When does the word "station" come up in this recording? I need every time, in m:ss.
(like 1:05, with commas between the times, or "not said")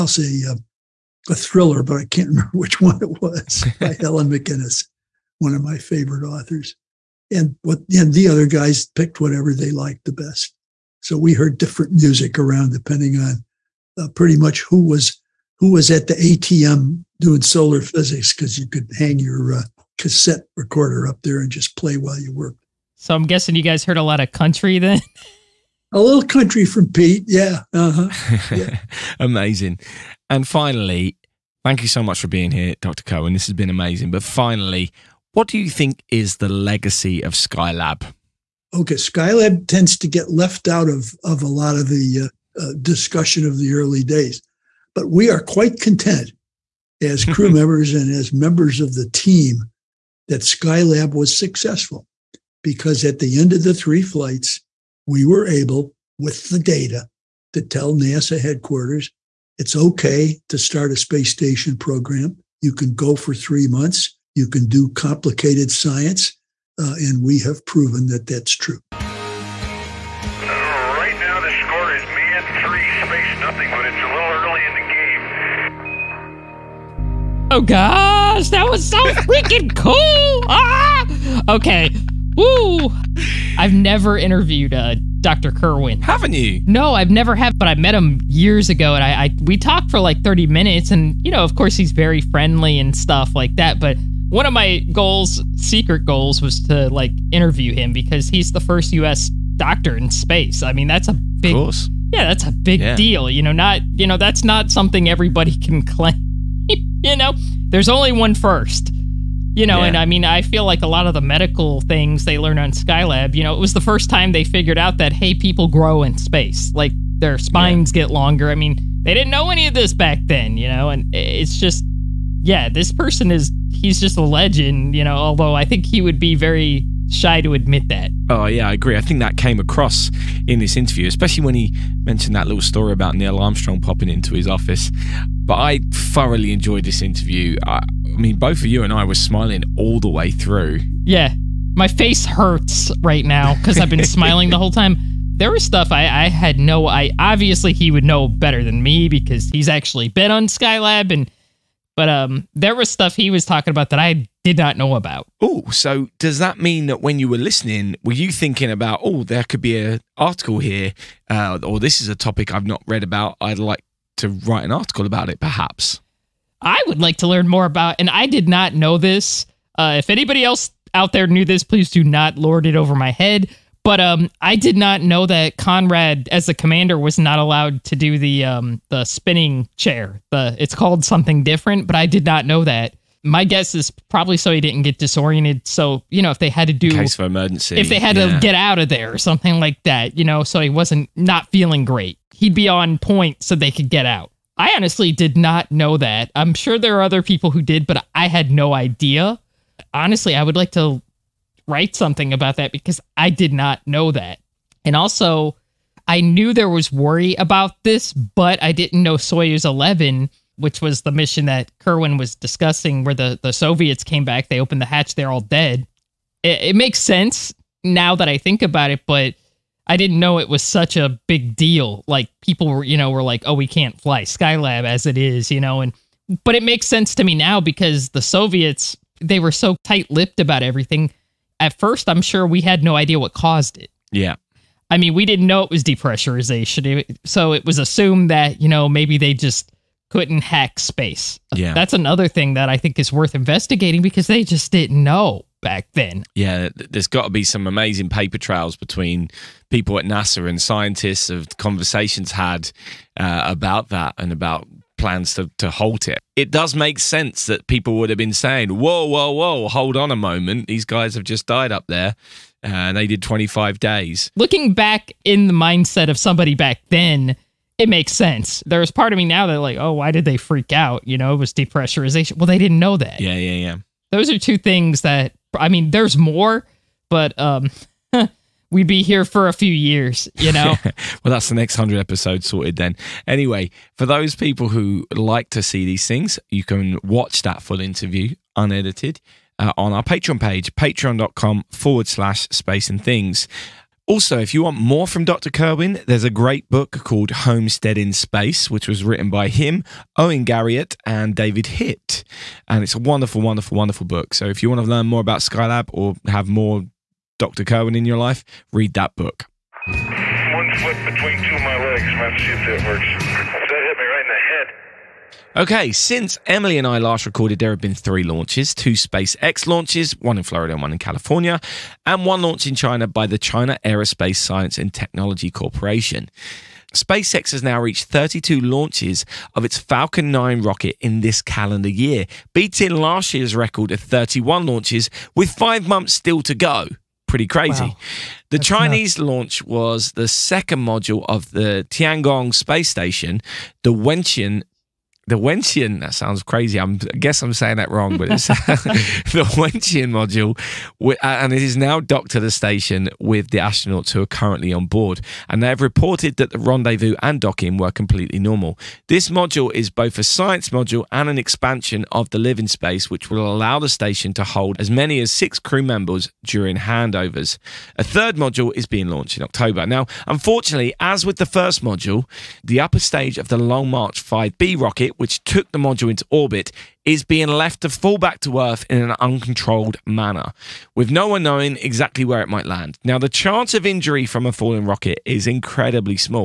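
1:01, 5:42, 5:52, 6:03.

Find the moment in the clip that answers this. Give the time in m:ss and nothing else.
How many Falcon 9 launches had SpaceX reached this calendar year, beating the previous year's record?
5:28.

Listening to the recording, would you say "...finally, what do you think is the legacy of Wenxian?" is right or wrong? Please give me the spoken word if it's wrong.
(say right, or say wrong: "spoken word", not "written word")
wrong: "Skylab", not "Wenxian".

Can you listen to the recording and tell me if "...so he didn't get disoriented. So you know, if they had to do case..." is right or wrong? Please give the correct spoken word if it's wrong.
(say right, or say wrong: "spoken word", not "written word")
right.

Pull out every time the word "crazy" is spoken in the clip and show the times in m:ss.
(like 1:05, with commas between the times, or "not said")
5:37, 5:46.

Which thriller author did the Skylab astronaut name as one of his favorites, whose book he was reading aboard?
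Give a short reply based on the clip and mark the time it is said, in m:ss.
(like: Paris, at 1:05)
Helen MacInnes, at 0:03.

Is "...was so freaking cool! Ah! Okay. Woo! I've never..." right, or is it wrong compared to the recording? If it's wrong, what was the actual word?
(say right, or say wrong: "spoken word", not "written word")
right.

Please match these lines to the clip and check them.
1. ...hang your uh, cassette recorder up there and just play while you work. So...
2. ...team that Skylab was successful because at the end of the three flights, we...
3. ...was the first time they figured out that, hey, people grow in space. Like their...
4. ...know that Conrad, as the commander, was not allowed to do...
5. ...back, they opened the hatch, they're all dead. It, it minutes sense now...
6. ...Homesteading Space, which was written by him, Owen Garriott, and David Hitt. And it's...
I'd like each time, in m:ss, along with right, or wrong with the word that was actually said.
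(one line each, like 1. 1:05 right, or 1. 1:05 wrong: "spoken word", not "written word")
1. 0:18 right
2. 0:49 right
3. 1:53 right
4. 2:55 right
5. 3:34 wrong: "makes", not "minutes"
6. 4:57 right.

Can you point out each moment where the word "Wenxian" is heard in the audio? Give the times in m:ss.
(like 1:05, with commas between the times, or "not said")
5:45, 5:49.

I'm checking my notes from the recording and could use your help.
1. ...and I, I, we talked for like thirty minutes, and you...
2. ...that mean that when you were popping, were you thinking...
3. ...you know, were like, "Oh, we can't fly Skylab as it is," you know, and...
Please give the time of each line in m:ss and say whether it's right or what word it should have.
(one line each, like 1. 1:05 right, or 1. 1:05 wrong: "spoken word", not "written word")
1. 1:28 right
2. 2:36 wrong: "listening", not "popping"
3. 3:42 right.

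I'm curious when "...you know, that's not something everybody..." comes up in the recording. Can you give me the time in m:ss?
1:43.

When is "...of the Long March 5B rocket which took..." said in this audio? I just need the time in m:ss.
6:13.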